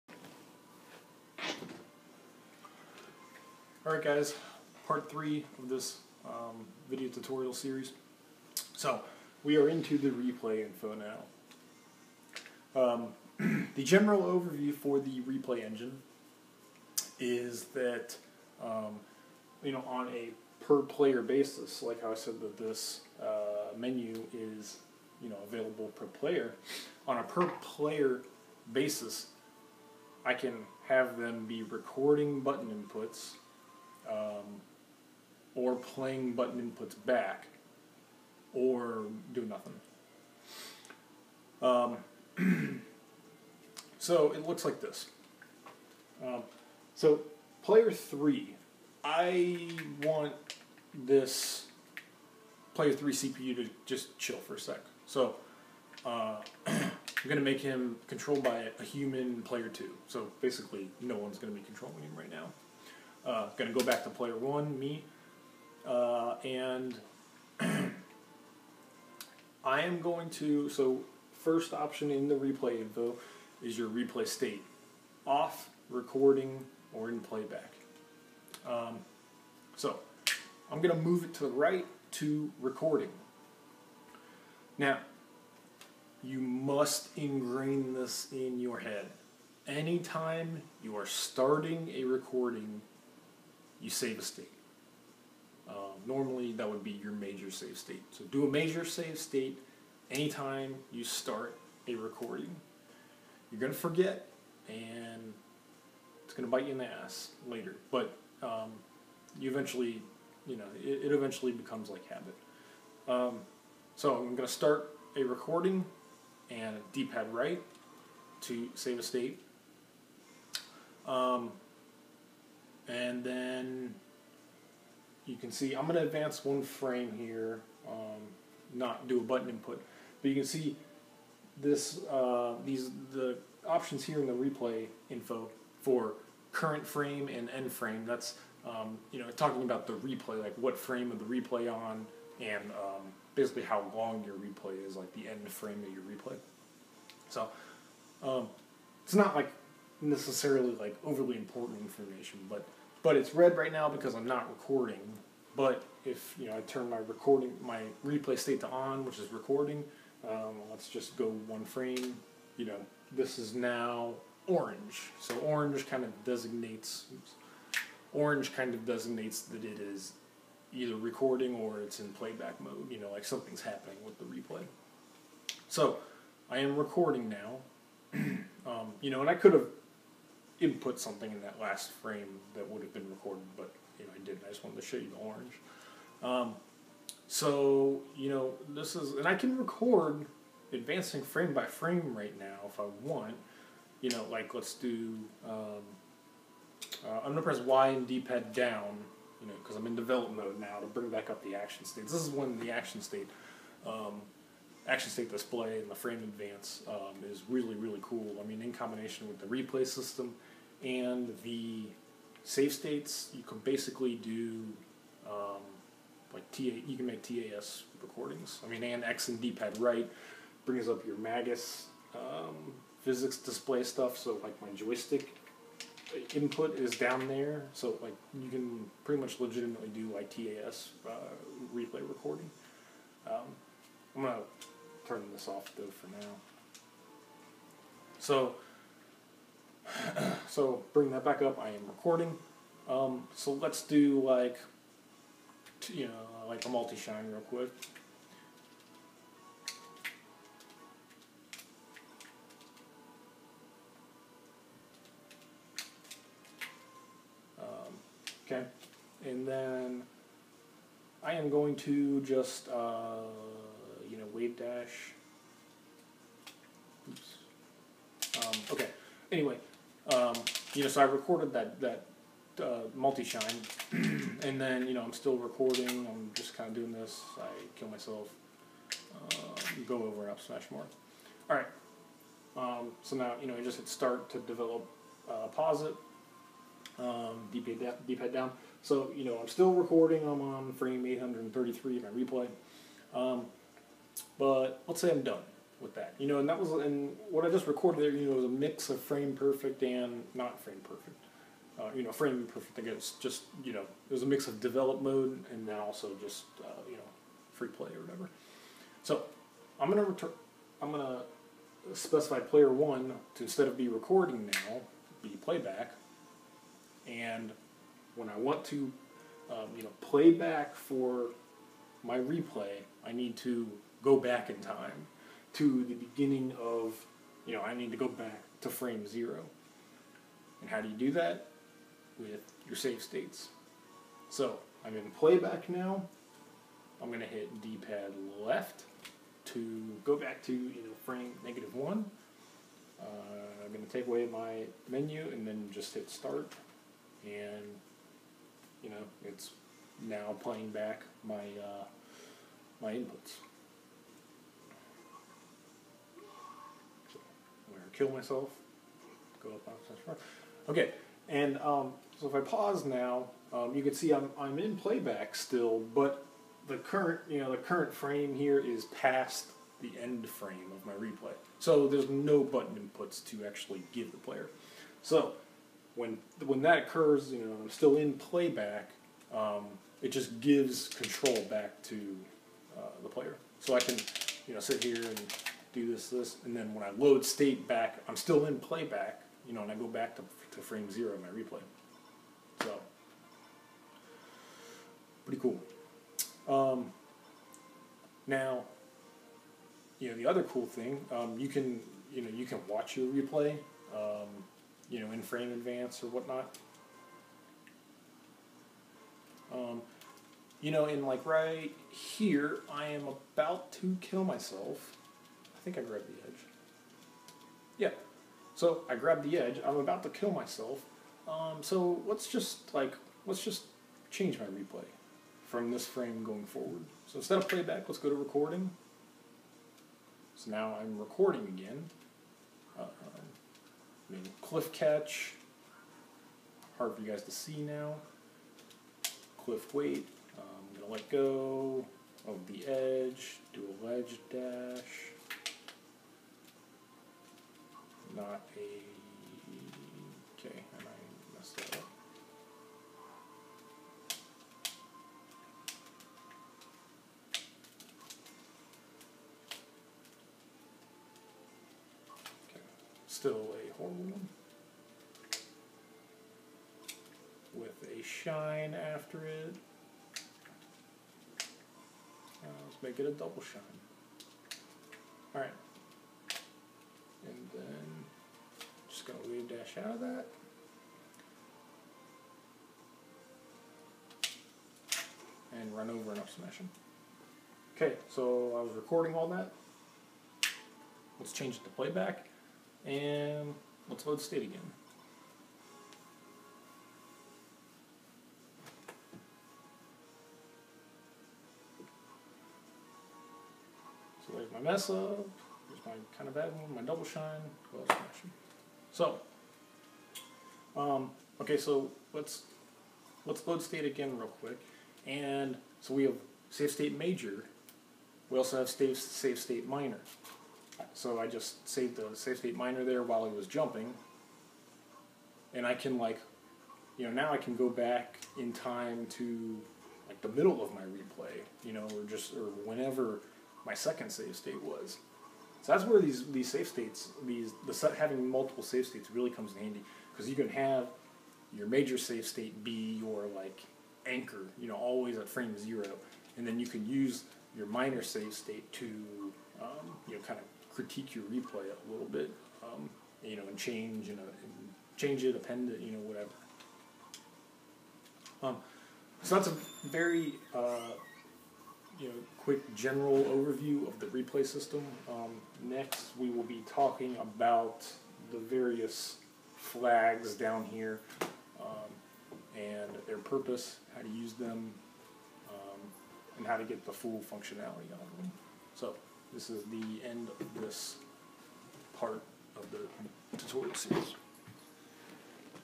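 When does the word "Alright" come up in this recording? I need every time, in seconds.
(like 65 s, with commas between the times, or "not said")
3 s, 475 s.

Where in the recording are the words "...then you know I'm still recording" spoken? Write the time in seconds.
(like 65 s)
274 s.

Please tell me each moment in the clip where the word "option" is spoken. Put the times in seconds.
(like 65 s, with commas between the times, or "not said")
71 s, 133 s.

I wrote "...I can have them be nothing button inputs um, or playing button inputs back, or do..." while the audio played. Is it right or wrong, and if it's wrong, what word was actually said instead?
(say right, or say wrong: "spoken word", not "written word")
wrong: "recording", not "nothing".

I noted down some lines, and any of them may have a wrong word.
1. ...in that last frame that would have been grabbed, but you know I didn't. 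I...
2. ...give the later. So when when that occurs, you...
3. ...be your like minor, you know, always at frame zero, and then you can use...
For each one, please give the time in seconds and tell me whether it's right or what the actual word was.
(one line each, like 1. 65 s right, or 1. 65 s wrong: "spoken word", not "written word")
1. 181 s wrong: "recorded", not "grabbed"
2. 373 s wrong: "player", not "later"
3. 542 s wrong: "anchor", not "minor".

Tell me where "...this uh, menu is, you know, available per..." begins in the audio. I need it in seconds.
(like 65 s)
22 s.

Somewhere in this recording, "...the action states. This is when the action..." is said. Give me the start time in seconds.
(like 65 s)
201 s.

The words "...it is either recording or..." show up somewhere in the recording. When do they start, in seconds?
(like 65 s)
169 s.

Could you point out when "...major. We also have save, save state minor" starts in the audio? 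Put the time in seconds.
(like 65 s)
516 s.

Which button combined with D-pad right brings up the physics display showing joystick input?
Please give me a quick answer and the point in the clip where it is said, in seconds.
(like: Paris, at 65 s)
X, at 219 s.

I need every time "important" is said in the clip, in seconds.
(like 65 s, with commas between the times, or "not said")
151 s.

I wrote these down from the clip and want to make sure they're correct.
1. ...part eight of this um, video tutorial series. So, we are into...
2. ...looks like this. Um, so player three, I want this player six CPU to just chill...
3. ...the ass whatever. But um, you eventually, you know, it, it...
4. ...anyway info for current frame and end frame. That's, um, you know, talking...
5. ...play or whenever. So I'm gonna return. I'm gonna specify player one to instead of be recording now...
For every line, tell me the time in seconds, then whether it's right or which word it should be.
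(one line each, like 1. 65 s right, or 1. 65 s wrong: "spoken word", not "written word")
1. 4 s wrong: "three", not "eight"
2. 44 s wrong: "three", not "six"
3. 106 s wrong: "later", not "whatever"
4. 134 s wrong: "replay", not "anyway"
5. 307 s wrong: "whatever", not "whenever".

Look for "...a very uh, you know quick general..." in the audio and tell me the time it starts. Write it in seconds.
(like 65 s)
559 s.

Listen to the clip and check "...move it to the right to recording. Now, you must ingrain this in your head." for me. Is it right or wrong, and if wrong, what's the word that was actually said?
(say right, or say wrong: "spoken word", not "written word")
right.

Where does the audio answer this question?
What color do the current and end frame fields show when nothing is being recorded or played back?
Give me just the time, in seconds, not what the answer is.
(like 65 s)
153 s.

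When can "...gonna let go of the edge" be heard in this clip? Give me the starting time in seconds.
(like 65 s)
440 s.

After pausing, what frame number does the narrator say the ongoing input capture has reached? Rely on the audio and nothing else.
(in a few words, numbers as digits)
833.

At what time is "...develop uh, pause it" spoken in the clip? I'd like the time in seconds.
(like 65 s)
284 s.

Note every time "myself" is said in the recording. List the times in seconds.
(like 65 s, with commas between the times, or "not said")
277 s, 358 s, 414 s, 420 s.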